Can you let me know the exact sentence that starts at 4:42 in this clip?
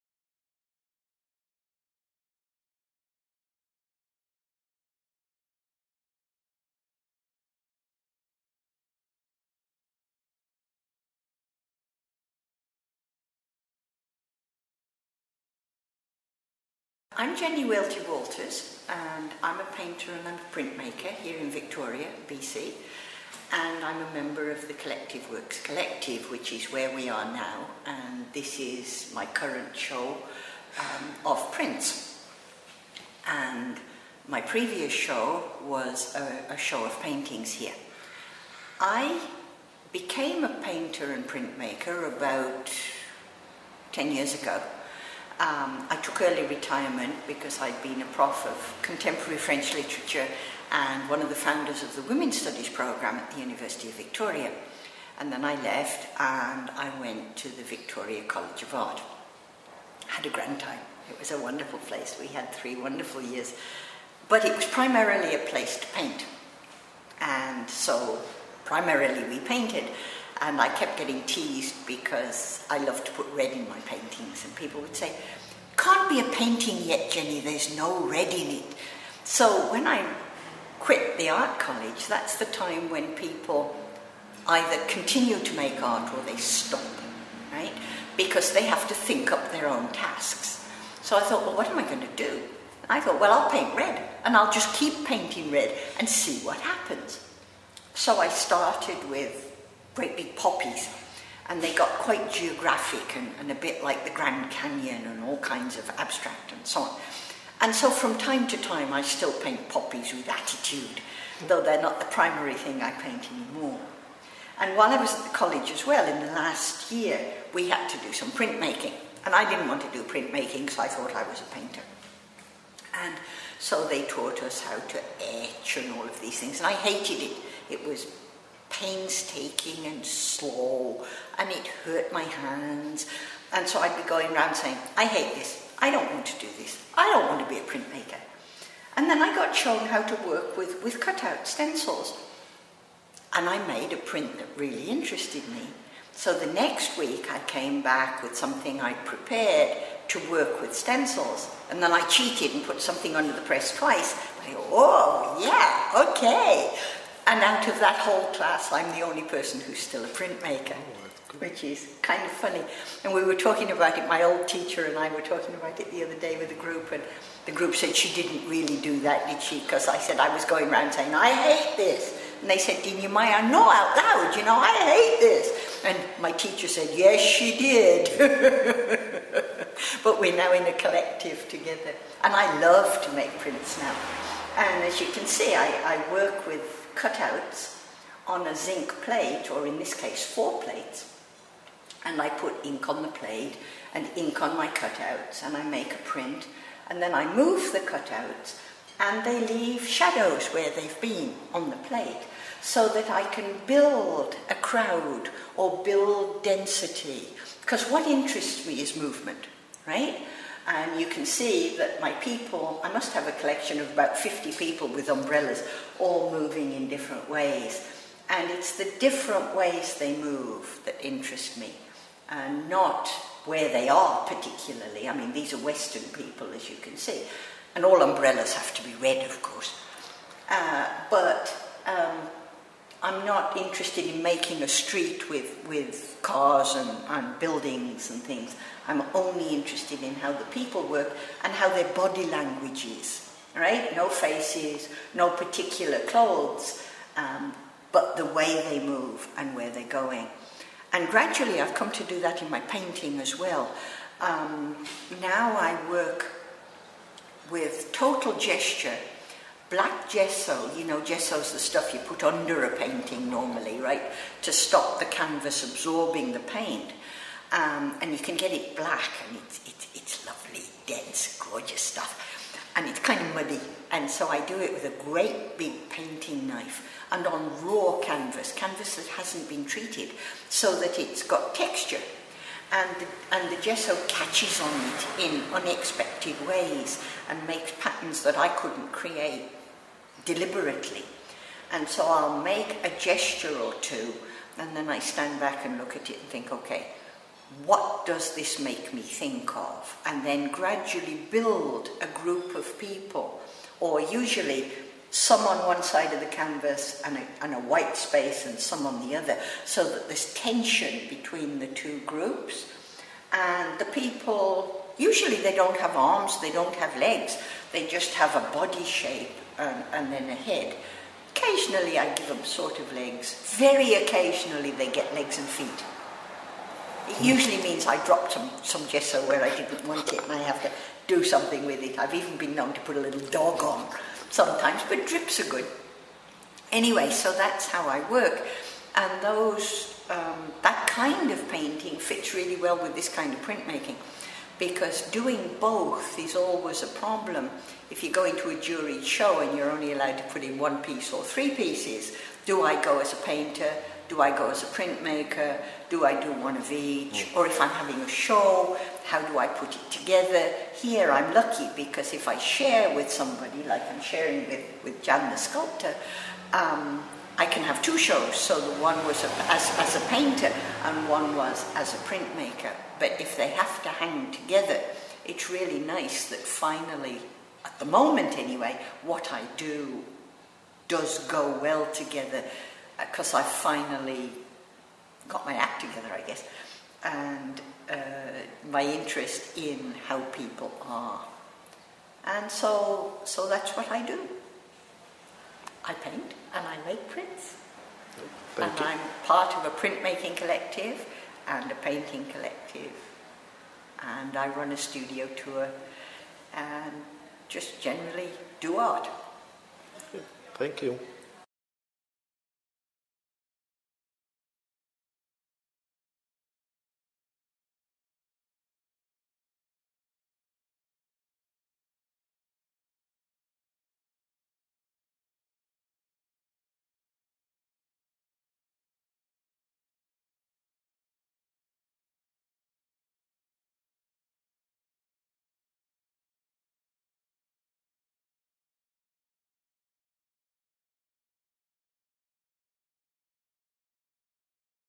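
And the, and the gesso catches on it in unexpected ways and makes patterns that I couldn't create deliberately.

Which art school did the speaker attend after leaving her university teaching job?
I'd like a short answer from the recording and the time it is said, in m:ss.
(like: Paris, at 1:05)
Victoria College of Art, at 0:57.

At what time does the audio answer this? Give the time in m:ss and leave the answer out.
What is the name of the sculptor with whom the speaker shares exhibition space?
6:05.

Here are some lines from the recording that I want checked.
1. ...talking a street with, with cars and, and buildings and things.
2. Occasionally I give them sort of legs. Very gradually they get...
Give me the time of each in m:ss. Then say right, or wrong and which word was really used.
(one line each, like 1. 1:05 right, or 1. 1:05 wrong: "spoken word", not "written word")
1. 3:54 wrong: "making", not "talking"
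2. 5:21 wrong: "occasionally", not "gradually".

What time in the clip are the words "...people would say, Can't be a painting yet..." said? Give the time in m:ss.
1:14.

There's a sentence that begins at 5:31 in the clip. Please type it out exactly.
I've even been known to put a little dog on sometimes, but drips are good.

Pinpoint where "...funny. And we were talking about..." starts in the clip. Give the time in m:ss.
2:42.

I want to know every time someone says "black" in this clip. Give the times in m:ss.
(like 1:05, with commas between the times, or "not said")
4:19, 4:28.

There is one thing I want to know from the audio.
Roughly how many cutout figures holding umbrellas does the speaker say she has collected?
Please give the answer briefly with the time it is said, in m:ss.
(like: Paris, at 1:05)
About 50, at 3:33.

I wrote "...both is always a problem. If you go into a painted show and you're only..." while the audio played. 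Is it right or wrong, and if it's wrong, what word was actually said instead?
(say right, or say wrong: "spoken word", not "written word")
wrong: "juried", not "painted".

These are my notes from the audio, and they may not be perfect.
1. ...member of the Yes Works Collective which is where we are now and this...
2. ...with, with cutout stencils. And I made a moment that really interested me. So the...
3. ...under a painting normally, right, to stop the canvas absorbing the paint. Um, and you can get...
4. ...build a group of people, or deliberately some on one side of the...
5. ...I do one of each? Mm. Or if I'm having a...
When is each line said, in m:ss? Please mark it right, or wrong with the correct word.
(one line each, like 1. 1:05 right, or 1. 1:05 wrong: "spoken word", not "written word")
1. 0:24 wrong: "Collective", not "Yes"
2. 2:20 wrong: "print", not "moment"
3. 4:22 right
4. 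5:01 wrong: "usually", not "deliberately"
5. 5:56 right.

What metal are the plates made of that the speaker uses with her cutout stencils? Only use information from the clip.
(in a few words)
Zinc.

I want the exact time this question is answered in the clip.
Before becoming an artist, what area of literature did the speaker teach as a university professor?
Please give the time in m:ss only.
0:48.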